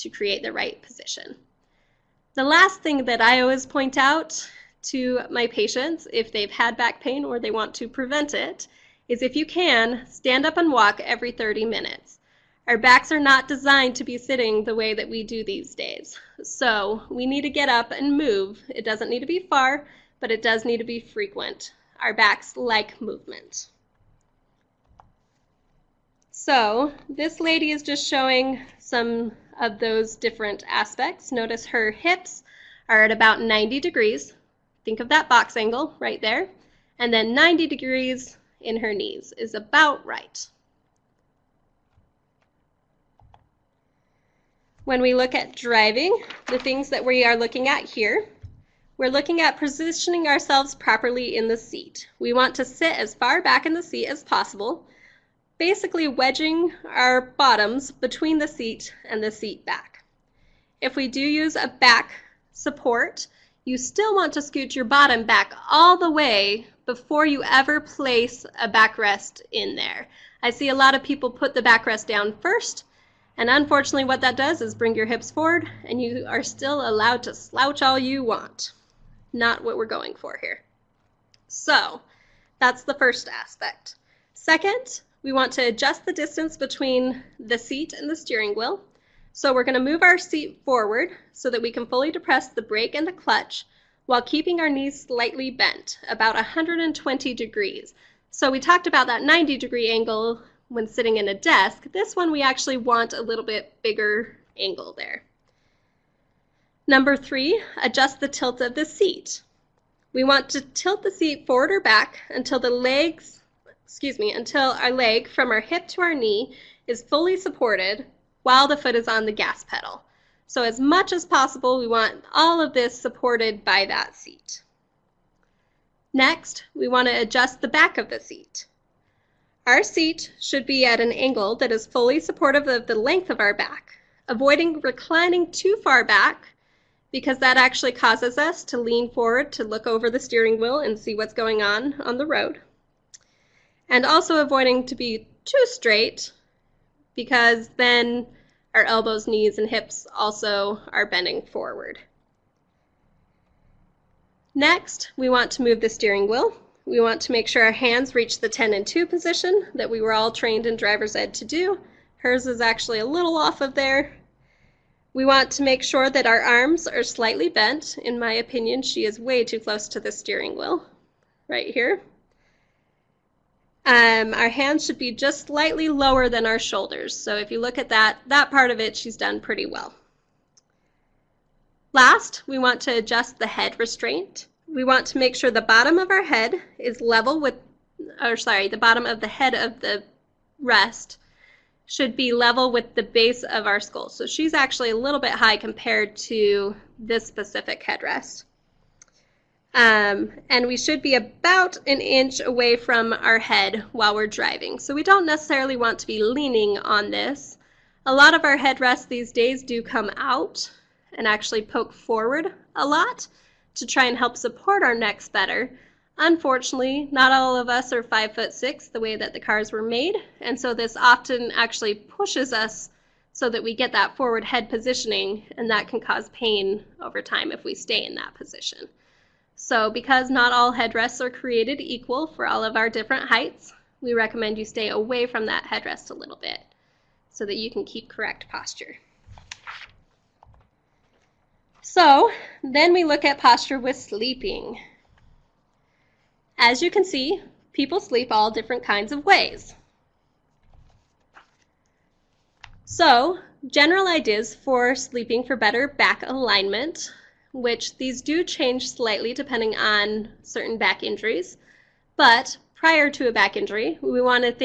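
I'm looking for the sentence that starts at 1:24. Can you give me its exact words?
Second, we want to adjust the distance between the seat and the steering wheel.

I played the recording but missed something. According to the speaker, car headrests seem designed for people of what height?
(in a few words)
five foot six.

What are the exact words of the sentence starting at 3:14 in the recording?
So she's actually a little bit high compared to this specific headrest.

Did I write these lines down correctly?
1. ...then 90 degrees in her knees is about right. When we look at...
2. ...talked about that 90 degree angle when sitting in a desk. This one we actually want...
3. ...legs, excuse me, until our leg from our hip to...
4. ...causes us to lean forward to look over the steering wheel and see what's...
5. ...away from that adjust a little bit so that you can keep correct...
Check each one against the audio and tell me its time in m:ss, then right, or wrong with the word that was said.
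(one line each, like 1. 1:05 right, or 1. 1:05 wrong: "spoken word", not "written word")
1. 0:37 right
2. 1:38 right
3. 1:52 right
4. 2:17 right
5. 3:54 wrong: "headrest", not "adjust".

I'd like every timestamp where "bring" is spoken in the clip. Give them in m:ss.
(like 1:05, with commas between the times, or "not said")
1:14.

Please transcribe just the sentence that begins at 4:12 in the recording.
So, general ideas for sleeping for better back alignment, which these do change slightly depending on certain back injuries.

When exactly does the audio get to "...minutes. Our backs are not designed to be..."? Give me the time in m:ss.
0:11.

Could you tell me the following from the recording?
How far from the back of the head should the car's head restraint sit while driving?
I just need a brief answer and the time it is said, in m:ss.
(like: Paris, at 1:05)
an inch, at 3:21.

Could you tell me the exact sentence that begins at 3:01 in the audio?
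Last, we want to adjust the head restraint.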